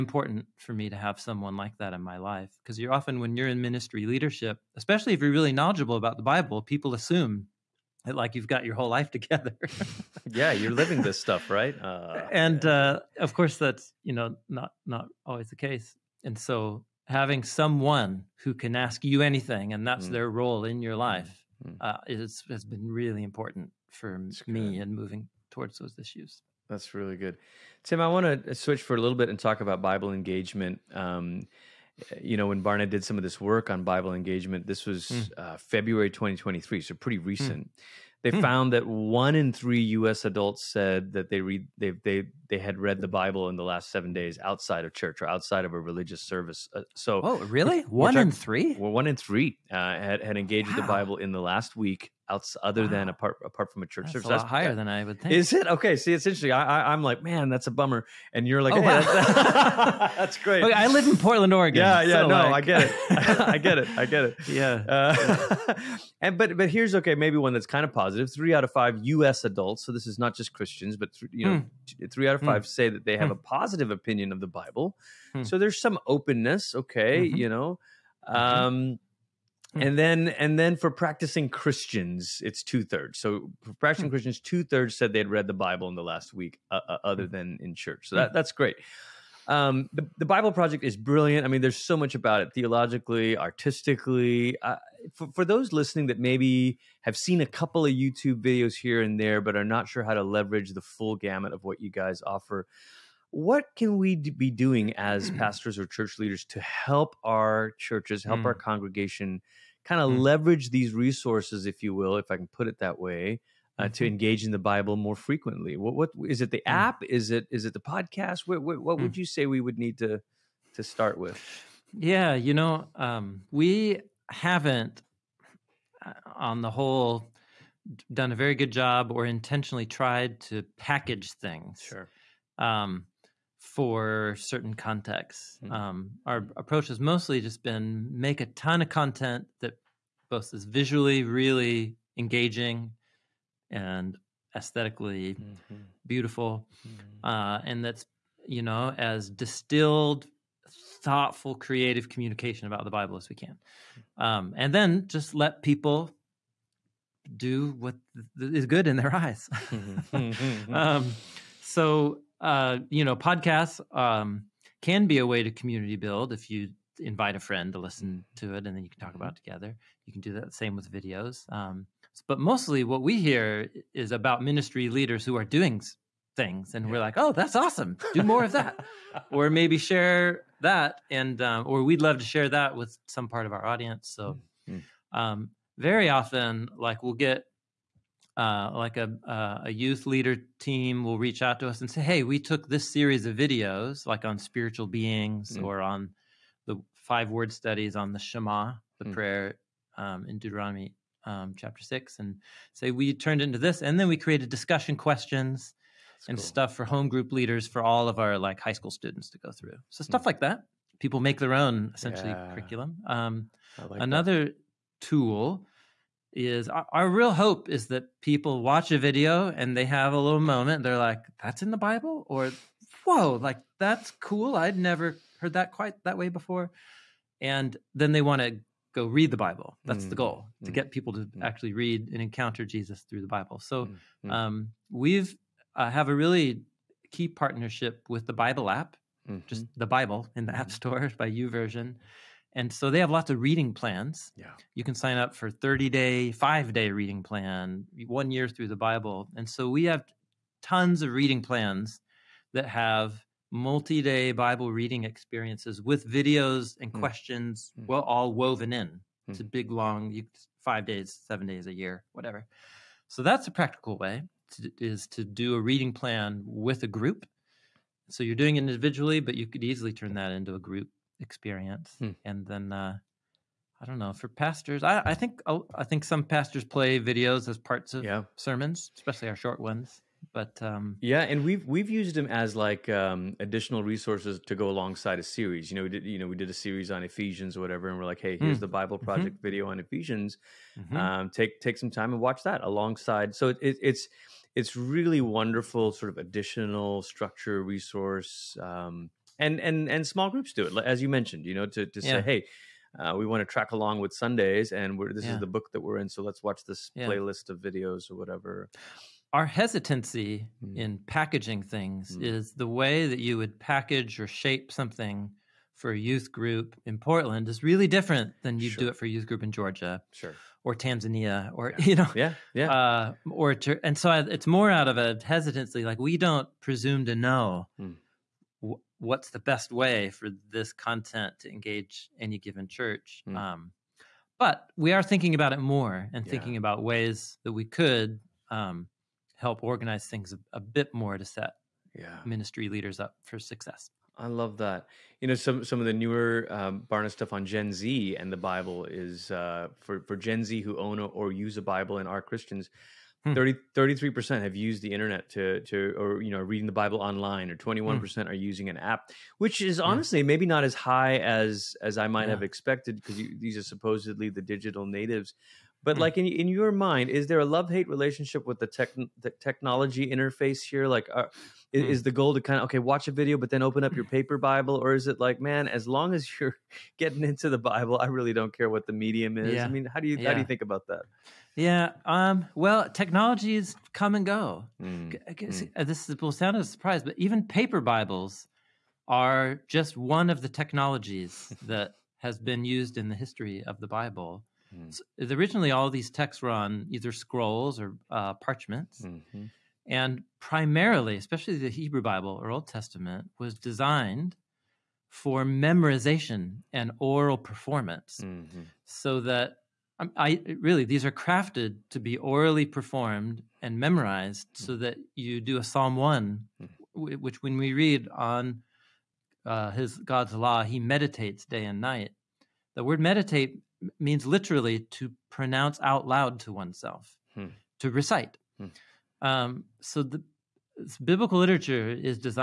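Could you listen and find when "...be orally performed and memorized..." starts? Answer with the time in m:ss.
6:52.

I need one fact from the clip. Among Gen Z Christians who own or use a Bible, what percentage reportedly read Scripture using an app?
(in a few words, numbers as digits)
21%.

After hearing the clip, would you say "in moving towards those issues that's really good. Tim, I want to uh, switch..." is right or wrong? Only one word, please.
right.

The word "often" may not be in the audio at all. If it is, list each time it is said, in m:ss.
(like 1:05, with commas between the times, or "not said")
0:02, 3:06.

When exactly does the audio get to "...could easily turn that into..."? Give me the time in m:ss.
4:29.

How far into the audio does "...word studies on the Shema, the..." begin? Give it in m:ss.
3:17.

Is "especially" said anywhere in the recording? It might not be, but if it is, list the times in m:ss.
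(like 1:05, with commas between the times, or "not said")
0:04, 4:38, 6:41.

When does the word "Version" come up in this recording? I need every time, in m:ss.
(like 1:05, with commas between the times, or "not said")
4:01.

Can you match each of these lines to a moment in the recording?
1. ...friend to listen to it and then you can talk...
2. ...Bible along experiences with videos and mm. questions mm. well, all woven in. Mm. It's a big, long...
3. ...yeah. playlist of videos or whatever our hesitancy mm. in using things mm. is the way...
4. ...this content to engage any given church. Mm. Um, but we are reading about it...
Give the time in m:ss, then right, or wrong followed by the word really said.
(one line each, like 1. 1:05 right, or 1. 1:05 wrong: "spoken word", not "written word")
1. 2:47 right
2. 4:14 wrong: "reading", not "along"
3. 5:06 wrong: "packaging", not "using"
4. 5:30 wrong: "thinking", not "reading".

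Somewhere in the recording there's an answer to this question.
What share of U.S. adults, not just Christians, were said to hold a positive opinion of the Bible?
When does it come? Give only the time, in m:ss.
1:08.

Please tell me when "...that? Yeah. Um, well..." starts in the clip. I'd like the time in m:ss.
6:20.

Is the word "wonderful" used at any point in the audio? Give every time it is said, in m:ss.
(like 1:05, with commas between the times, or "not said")
4:55.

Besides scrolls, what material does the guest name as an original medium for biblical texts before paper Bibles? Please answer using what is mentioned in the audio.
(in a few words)
Parchments.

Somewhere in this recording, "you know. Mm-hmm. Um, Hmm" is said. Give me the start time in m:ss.
1:17.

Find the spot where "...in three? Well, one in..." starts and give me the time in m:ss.
0:48.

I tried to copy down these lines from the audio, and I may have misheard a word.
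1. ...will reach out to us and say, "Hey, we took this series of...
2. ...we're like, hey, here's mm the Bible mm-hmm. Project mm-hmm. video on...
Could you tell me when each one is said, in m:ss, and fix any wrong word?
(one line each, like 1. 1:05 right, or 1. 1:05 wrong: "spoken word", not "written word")
1. 3:11 right
2. 4:47 right.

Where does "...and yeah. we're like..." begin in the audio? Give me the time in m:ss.
2:56.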